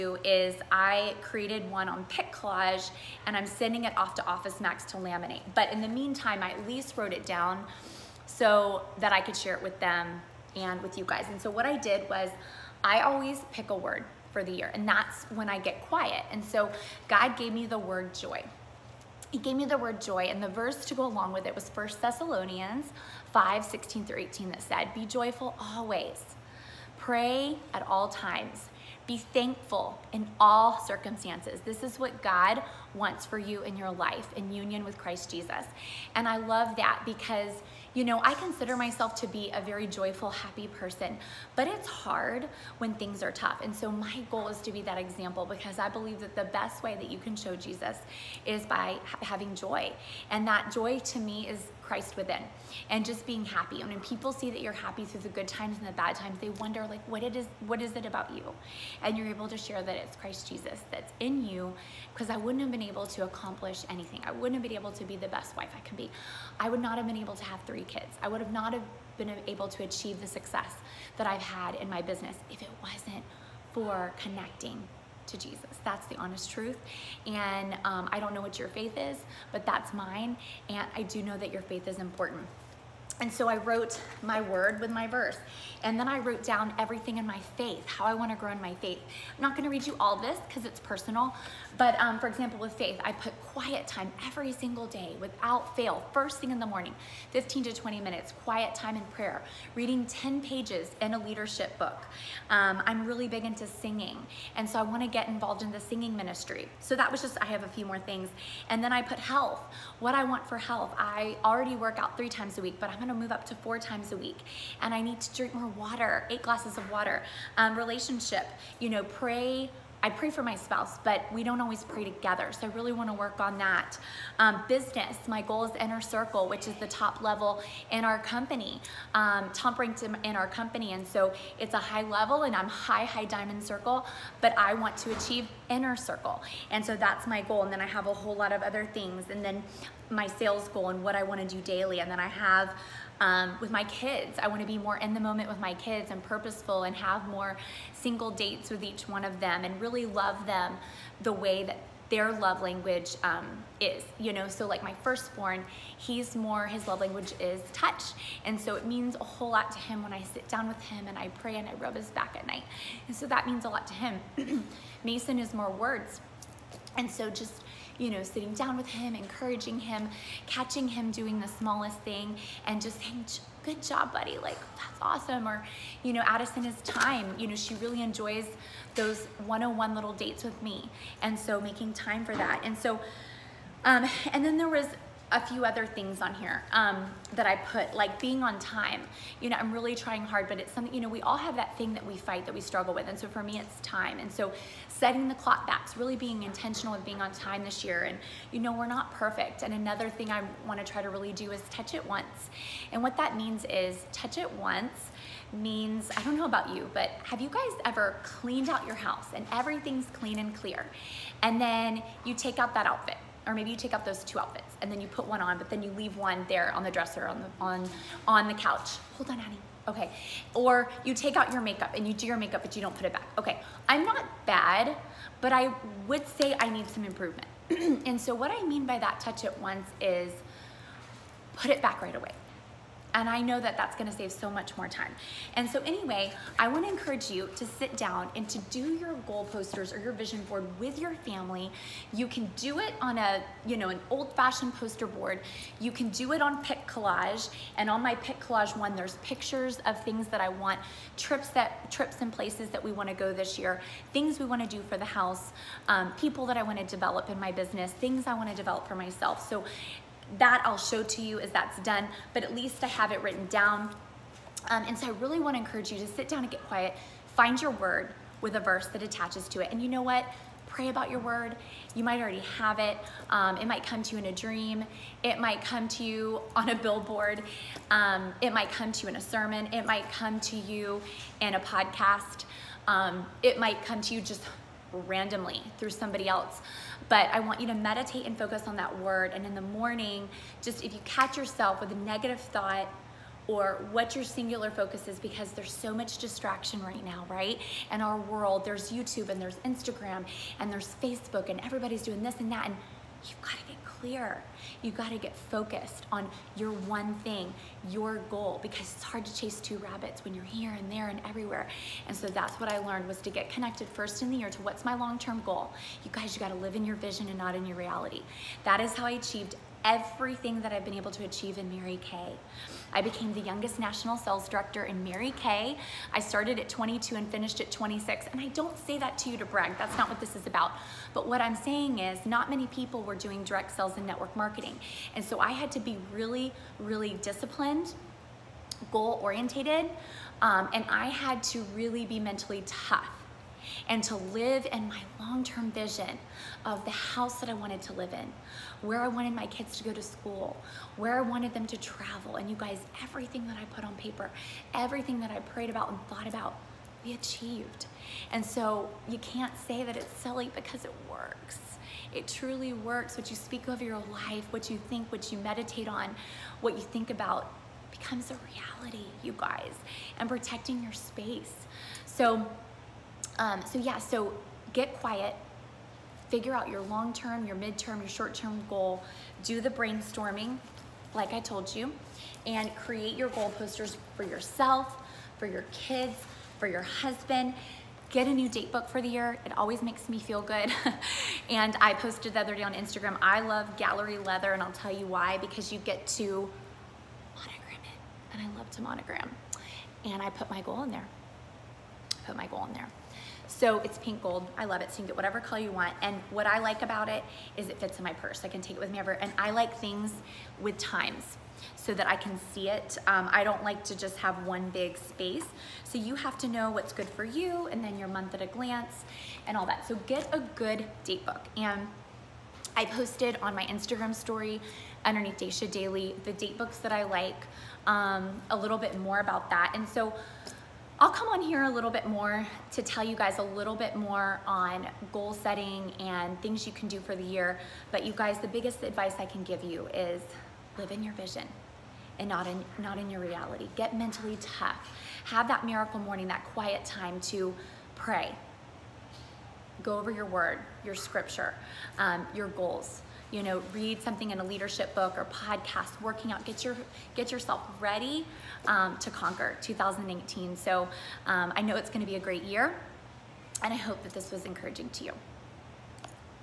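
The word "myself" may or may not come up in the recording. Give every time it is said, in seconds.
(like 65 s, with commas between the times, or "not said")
38 s, 258 s.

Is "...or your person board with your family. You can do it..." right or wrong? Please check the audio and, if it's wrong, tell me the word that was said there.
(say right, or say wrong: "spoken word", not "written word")
wrong: "vision", not "person".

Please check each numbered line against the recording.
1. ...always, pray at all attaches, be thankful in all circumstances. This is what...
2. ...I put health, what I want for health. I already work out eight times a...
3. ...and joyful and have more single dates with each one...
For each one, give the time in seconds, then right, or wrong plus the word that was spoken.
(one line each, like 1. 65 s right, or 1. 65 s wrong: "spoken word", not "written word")
1. 25 s wrong: "times", not "attaches"
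2. 108 s wrong: "three", not "eight"
3. 146 s wrong: "purposeful", not "joyful".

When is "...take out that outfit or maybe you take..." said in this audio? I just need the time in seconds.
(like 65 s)
212 s.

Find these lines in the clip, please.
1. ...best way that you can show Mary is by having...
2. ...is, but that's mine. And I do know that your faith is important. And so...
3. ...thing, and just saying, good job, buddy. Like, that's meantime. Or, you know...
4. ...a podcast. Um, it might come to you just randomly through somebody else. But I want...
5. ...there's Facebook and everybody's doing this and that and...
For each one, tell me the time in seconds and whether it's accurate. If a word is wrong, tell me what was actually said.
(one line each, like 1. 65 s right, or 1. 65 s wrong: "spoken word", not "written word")
1. 46 s wrong: "Jesus", not "Mary"
2. 78 s right
3. 171 s wrong: "awesome", not "meantime"
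4. 281 s right
5. 300 s right.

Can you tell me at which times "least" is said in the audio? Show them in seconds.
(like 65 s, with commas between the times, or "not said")
6 s, 262 s.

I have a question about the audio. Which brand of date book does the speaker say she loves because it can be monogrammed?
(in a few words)
Gallery Leather.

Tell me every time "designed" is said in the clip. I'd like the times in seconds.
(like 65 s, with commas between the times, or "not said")
not said.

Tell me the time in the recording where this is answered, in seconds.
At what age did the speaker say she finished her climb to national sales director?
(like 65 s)
327 s.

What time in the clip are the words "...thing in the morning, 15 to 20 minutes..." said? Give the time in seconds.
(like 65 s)
96 s.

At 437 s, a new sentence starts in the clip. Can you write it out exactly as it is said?
But you guys, the biggest advice I can give you is live in your vision and not in, not in your reality.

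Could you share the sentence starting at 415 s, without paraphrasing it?
So you have to know what's good for you and then your month at a glance and all that.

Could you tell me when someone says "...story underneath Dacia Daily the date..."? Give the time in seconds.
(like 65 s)
424 s.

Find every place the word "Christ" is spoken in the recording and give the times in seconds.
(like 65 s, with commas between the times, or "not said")
34 s, 51 s, 60 s.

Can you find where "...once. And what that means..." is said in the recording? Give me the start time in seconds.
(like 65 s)
202 s.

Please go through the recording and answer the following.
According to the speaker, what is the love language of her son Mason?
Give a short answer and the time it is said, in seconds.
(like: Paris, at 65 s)
words, at 165 s.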